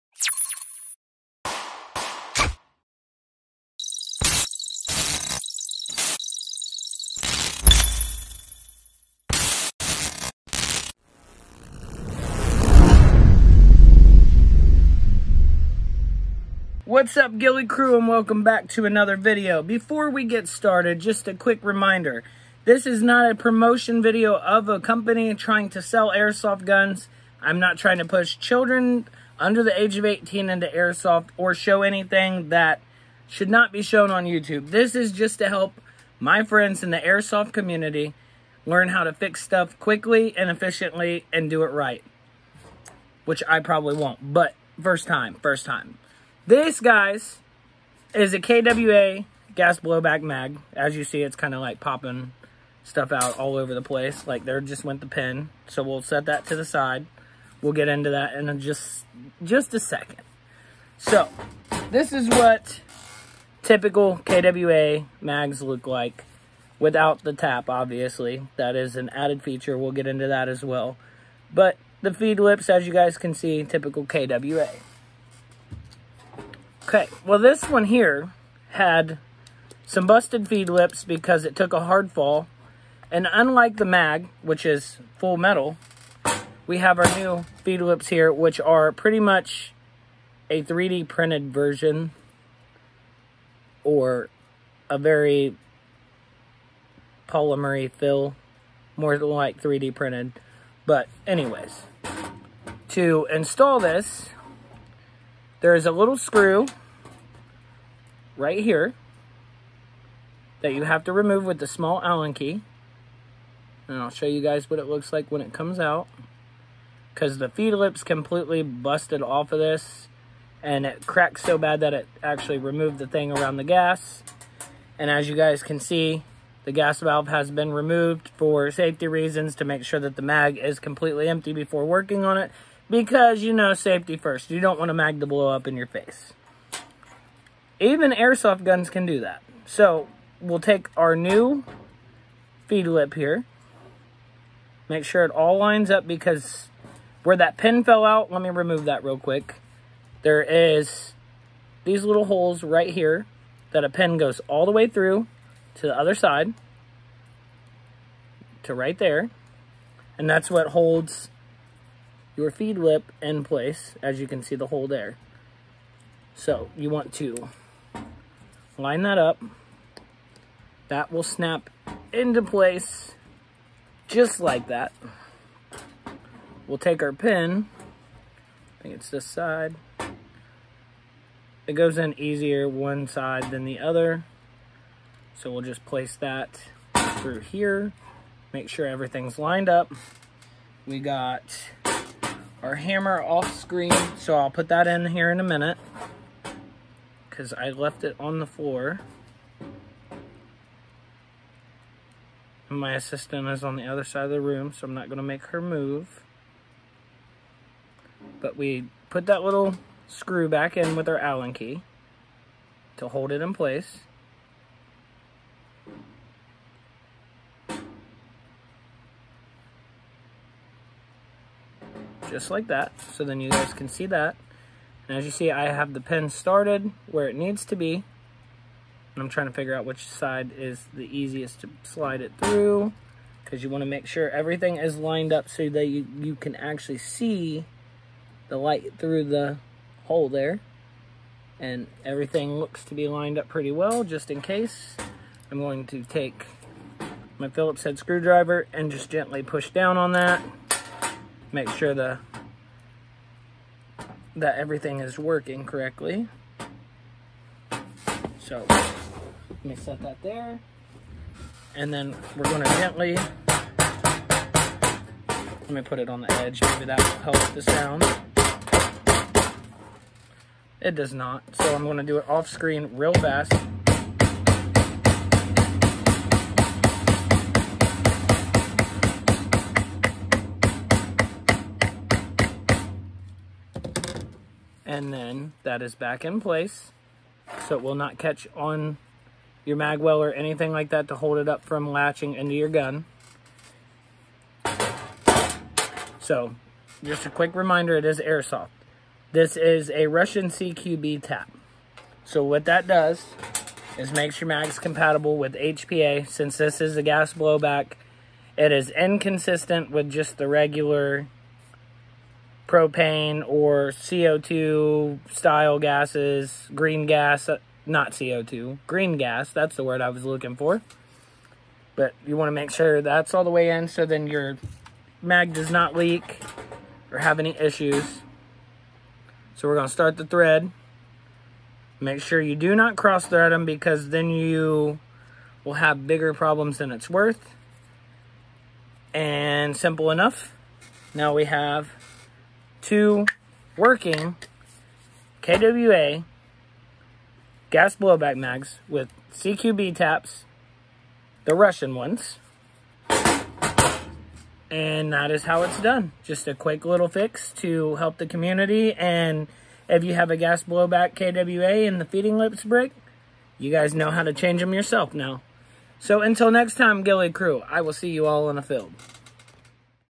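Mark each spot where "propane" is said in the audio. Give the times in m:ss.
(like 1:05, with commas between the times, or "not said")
5:12.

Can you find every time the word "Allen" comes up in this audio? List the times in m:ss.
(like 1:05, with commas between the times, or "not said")
1:52, 3:31.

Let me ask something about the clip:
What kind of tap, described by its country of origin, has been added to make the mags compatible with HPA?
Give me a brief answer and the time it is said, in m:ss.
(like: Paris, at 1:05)
Russian CQB tap, at 5:00.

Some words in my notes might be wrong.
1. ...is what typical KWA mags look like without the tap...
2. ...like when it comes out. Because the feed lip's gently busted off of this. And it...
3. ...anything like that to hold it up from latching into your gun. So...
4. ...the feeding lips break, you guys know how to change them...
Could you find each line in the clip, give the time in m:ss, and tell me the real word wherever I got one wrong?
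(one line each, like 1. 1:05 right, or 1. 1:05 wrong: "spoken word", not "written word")
1. 1:02 right
2. 1:55 wrong: "completely", not "gently"
3. 4:50 right
4. 6:01 right.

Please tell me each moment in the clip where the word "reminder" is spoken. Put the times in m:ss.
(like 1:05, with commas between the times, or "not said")
0:21, 4:57.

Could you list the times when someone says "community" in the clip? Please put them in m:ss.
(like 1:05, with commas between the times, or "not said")
0:37, 5:58.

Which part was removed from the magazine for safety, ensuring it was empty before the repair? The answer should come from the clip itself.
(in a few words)
gas valve.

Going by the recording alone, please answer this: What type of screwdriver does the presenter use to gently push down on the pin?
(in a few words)
Phillips head.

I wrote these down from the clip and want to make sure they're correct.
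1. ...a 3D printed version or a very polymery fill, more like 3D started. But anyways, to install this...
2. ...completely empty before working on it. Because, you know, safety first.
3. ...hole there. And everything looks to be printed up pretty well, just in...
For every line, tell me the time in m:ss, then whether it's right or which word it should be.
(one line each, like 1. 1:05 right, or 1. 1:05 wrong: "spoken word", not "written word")
1. 1:30 wrong: "printed", not "started"
2. 2:10 right
3. 4:00 wrong: "lined", not "printed".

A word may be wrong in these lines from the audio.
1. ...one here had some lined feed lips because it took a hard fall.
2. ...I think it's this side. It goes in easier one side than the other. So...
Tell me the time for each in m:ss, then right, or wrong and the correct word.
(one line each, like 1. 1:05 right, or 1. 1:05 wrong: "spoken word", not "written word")
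1. 1:17 wrong: "busted", not "lined"
2. 2:58 right.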